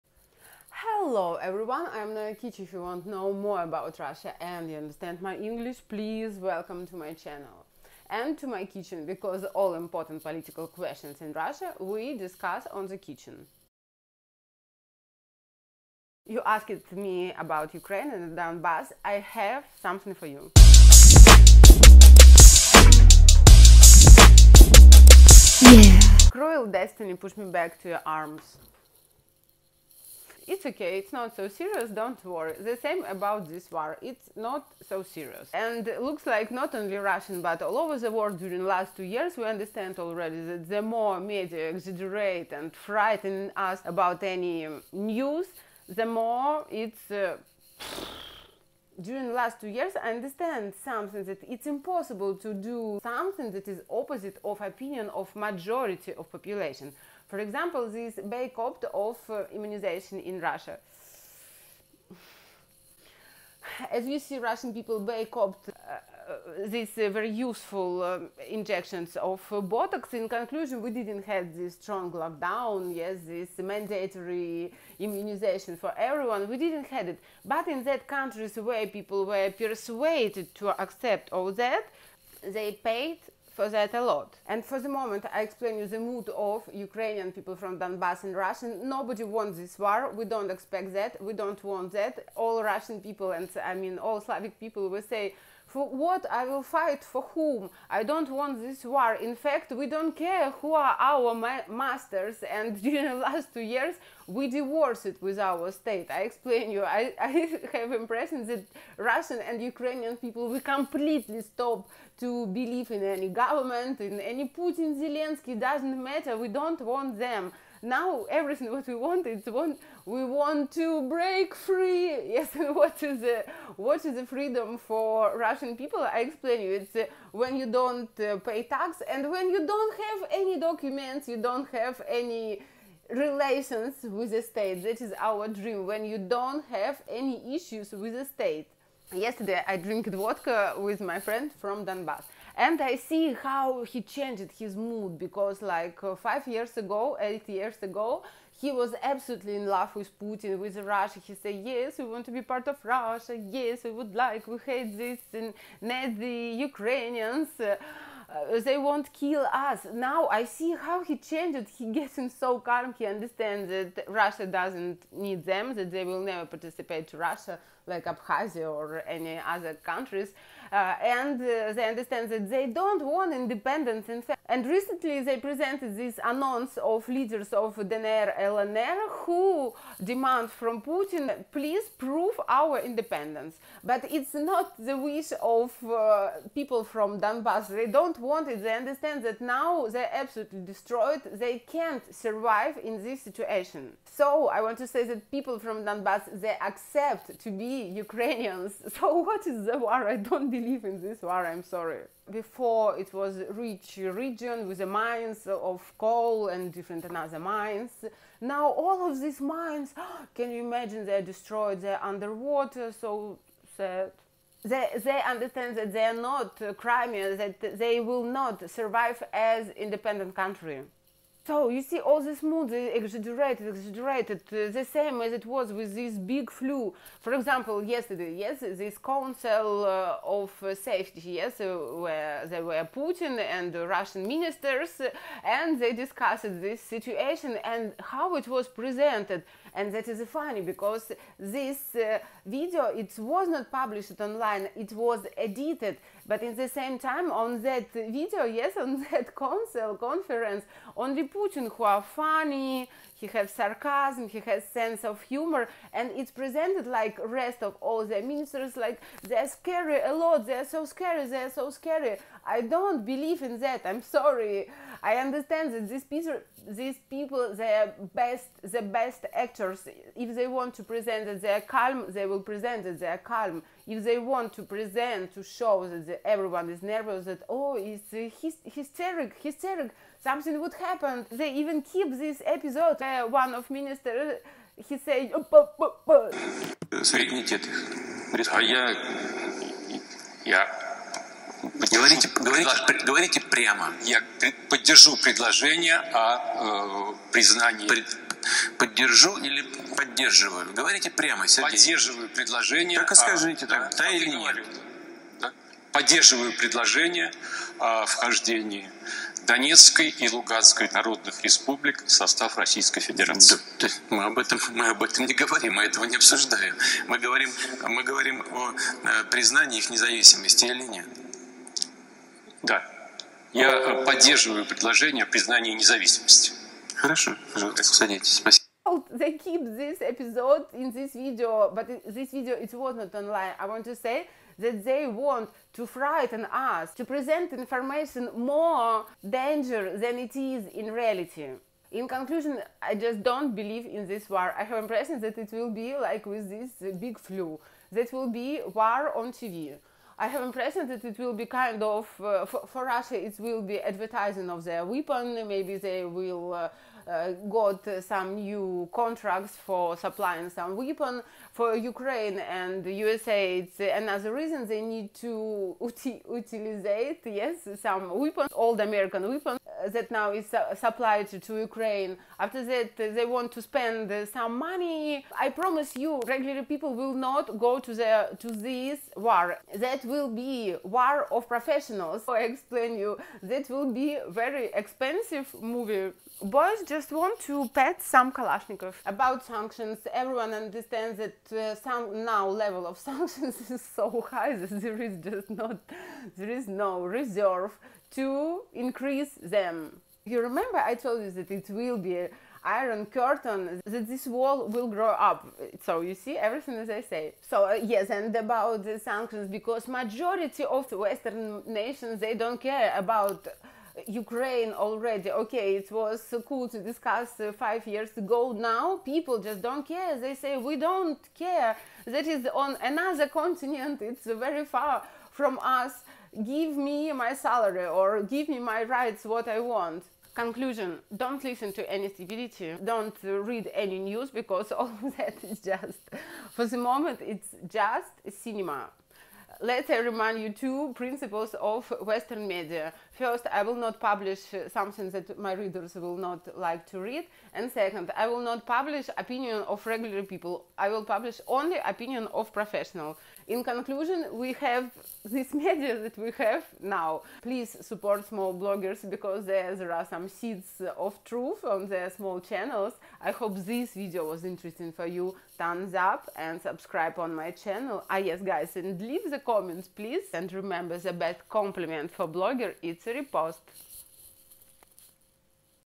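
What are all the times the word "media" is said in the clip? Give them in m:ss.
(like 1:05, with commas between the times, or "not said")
0:41, 7:22, 7:35.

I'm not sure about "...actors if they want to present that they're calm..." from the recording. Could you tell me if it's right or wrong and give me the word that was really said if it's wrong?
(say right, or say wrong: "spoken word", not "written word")
right.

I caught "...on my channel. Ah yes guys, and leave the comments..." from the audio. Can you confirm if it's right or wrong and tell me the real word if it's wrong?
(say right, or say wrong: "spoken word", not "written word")
right.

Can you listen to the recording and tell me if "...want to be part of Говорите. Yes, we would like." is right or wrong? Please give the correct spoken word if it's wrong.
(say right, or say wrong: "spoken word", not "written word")
wrong: "Russia", not "Говорите".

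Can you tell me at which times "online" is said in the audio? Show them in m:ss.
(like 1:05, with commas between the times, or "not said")
4:04, 5:33.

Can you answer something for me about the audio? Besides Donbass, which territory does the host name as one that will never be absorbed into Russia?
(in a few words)
Abkhazia.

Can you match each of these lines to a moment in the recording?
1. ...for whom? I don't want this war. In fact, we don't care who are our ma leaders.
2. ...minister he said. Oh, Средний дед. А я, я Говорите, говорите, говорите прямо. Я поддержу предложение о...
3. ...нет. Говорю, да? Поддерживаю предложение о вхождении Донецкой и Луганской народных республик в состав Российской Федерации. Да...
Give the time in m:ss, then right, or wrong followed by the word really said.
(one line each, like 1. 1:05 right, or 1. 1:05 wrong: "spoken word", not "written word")
1. 1:37 wrong: "masters", not "leaders"
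2. 4:43 right
3. 5:04 right.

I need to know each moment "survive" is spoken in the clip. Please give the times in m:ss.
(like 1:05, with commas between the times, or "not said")
3:12, 3:38.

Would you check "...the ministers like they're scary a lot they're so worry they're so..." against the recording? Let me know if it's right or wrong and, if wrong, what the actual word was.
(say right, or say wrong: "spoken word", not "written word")
wrong: "scary", not "worry".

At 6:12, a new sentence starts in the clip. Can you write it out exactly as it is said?
After that, they want to spend some money.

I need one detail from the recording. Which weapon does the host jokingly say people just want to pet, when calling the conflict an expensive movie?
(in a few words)
Kalashnikov.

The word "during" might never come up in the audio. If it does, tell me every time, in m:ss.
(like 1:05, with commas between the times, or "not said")
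0:38, 0:49, 1:42.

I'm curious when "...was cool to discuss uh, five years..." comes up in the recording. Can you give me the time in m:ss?
6:55.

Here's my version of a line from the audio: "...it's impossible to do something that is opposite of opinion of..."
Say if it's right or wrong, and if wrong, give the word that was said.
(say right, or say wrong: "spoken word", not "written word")
right.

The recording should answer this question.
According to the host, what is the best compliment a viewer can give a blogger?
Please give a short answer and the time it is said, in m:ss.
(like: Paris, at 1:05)
A repost, at 7:53.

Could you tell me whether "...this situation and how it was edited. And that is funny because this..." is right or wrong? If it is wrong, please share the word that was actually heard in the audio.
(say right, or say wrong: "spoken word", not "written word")
wrong: "presented", not "edited".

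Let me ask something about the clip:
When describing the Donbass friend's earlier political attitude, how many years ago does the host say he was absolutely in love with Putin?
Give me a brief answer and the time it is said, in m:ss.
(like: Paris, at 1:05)
8, at 2:27.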